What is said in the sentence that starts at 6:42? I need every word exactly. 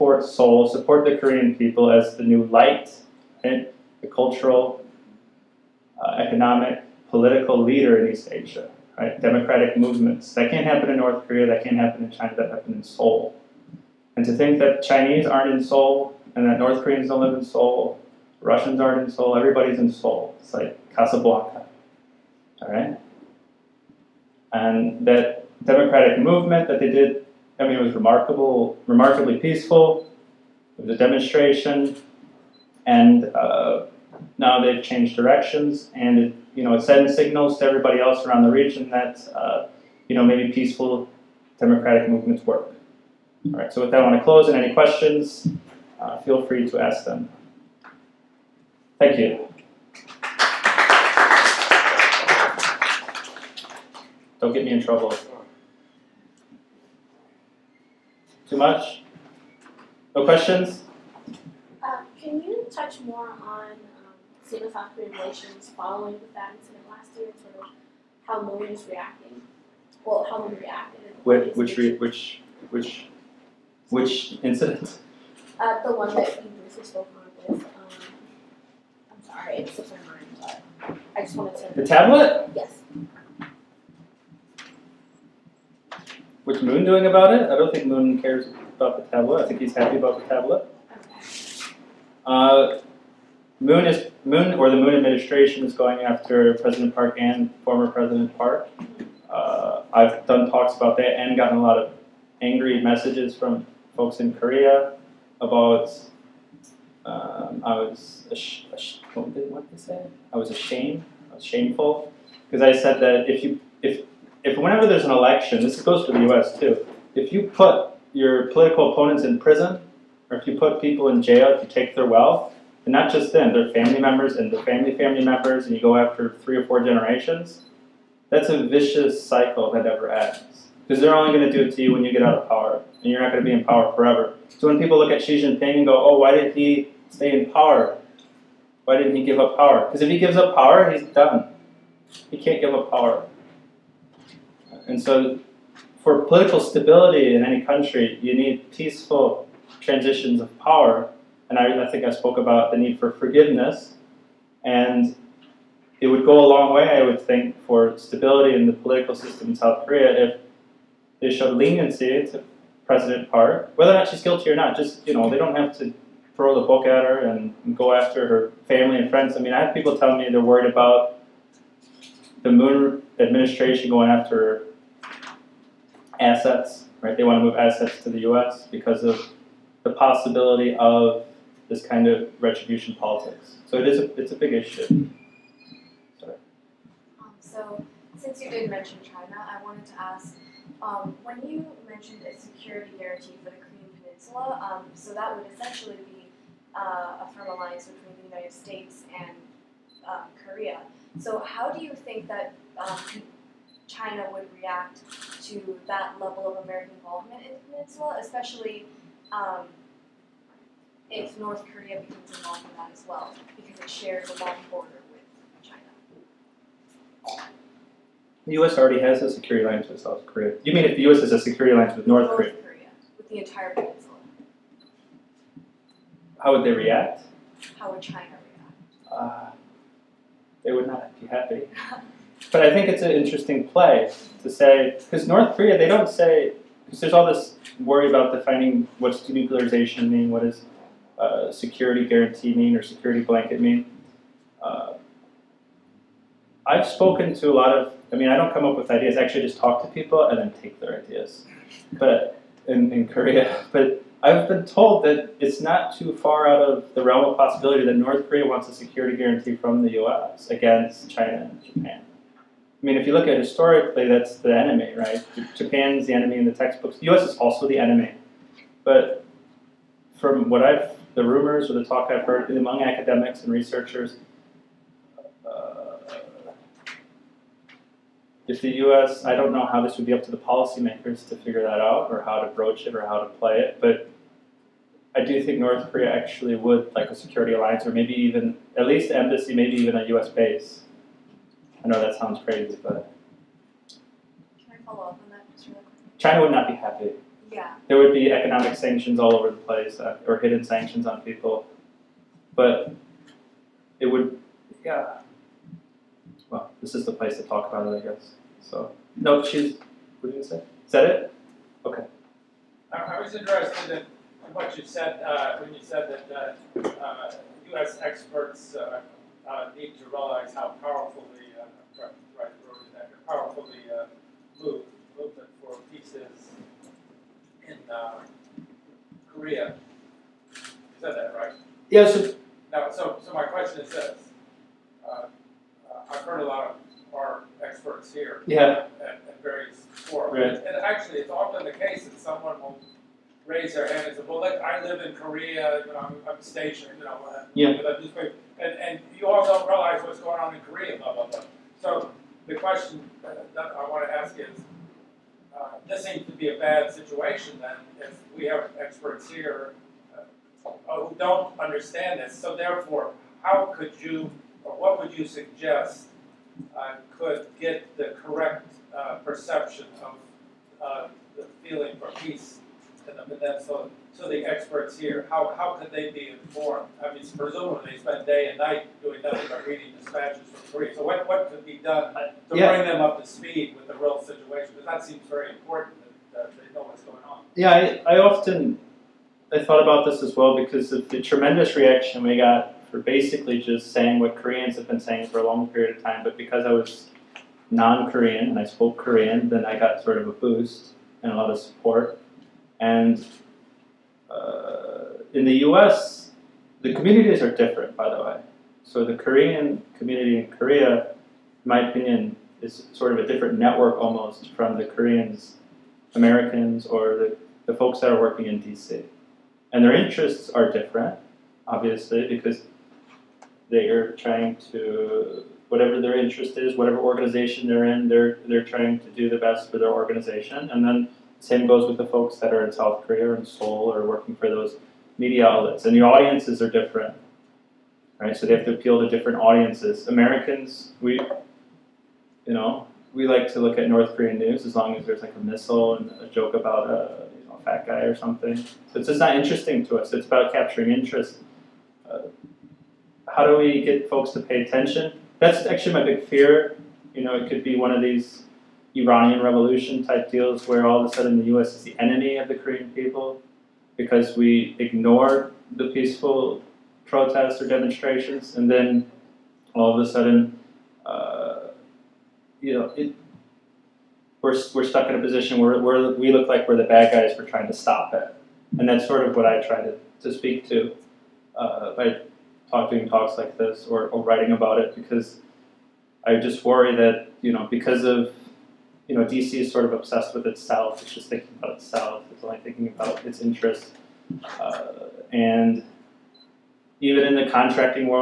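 And uh, in the U.S., the communities are different, by the way.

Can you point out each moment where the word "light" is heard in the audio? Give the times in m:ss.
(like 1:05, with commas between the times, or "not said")
0:02.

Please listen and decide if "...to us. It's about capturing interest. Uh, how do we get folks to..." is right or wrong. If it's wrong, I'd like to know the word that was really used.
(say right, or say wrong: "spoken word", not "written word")
right.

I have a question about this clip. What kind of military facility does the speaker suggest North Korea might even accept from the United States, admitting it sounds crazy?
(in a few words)
A U.S. base.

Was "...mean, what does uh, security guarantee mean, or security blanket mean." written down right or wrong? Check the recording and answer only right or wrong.
right.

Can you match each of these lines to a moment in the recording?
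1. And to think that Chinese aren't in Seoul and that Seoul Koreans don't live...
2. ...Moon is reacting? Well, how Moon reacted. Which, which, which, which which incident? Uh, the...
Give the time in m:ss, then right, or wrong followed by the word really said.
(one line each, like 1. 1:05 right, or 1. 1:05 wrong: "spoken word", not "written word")
1. 0:14 wrong: "North", not "Seoul"
2. 1:08 right.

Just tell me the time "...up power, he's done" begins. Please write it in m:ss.
2:20.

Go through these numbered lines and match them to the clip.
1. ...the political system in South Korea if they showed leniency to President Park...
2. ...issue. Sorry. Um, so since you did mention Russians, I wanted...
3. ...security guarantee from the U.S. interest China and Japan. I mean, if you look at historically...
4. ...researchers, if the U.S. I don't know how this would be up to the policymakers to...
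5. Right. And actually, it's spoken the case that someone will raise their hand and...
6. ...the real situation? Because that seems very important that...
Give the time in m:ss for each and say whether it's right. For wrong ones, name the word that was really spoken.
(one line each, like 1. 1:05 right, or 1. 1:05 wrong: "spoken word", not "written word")
1. 2:38 right
2. 3:04 wrong: "China", not "Russians"
3. 4:18 wrong: "against", not "interest"
4. 4:33 right
5. 5:40 wrong: "often", not "spoken"
6. 6:23 right.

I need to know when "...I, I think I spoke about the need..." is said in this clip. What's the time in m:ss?
2:31.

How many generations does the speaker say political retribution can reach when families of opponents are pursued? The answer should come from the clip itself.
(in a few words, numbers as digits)
3 or 4.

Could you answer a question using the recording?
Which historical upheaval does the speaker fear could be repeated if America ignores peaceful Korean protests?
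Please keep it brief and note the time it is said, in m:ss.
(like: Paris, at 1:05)
Iranian revolution, at 7:38.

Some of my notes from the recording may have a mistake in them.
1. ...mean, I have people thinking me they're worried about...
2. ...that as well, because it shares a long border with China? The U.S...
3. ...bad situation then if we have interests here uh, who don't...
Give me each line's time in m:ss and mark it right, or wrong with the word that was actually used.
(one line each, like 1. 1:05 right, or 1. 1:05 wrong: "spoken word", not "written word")
1. 2:49 wrong: "telling", not "thinking"
2. 3:32 right
3. 5:56 wrong: "experts", not "interests".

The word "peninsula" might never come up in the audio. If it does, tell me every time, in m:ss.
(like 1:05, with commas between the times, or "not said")
3:14, 3:27, 3:43, 6:13.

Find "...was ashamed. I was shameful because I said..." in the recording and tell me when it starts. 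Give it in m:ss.
1:50.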